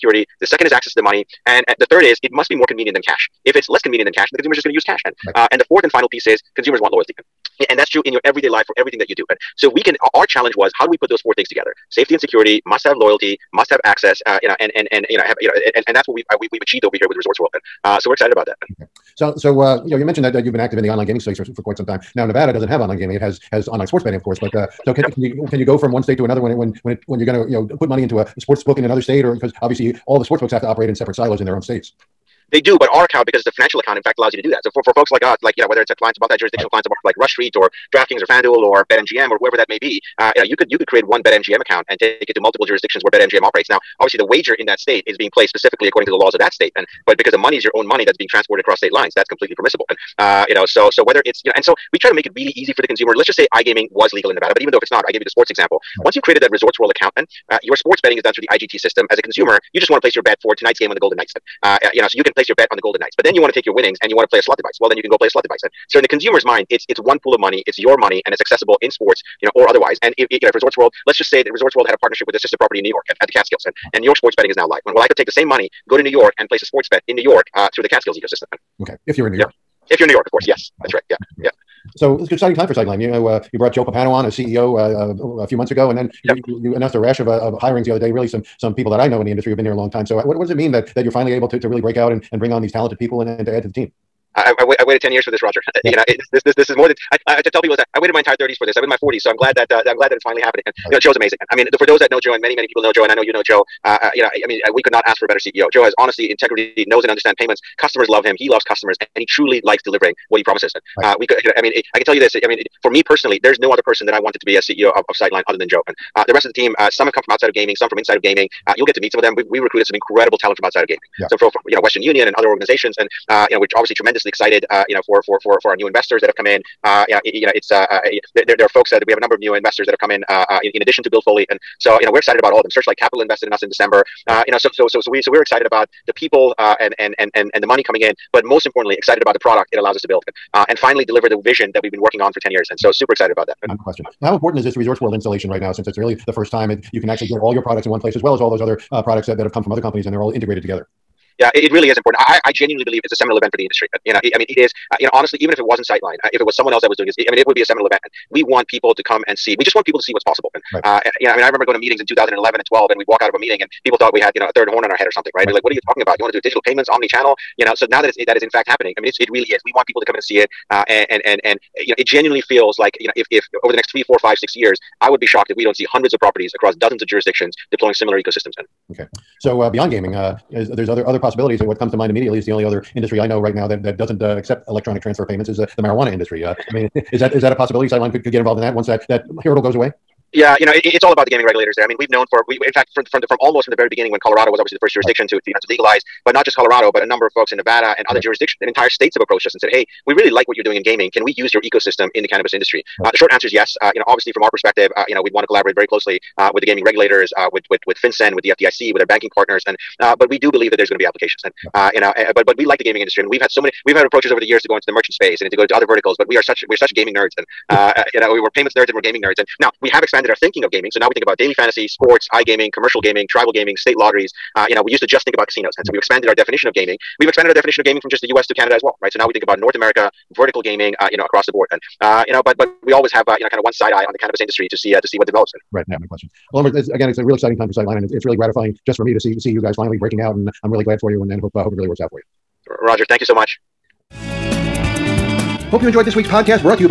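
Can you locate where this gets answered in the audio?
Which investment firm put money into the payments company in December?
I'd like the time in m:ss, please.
2:12.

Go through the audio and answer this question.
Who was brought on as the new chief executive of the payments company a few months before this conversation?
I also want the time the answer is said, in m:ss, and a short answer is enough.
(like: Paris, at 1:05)
Joe Pappano, at 1:23.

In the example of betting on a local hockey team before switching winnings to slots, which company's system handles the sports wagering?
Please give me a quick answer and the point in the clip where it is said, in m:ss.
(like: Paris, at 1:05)
IGT, at 0:58.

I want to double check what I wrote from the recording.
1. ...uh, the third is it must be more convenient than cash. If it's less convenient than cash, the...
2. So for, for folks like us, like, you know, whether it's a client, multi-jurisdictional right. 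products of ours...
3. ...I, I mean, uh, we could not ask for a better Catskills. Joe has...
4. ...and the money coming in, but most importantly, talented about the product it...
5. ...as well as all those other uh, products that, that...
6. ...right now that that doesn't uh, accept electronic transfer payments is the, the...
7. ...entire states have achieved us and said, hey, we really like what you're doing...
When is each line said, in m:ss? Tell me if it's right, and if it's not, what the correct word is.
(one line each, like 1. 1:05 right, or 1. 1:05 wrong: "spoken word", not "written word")
1. 0:01 right
2. 0:34 wrong: "clients", not "products"
3. 1:44 wrong: "CEO", not "Catskills"
4. 2:17 wrong: "excited", not "talented"
5. 2:28 right
6. 3:03 right
7. 3:18 wrong: "approached", not "achieved".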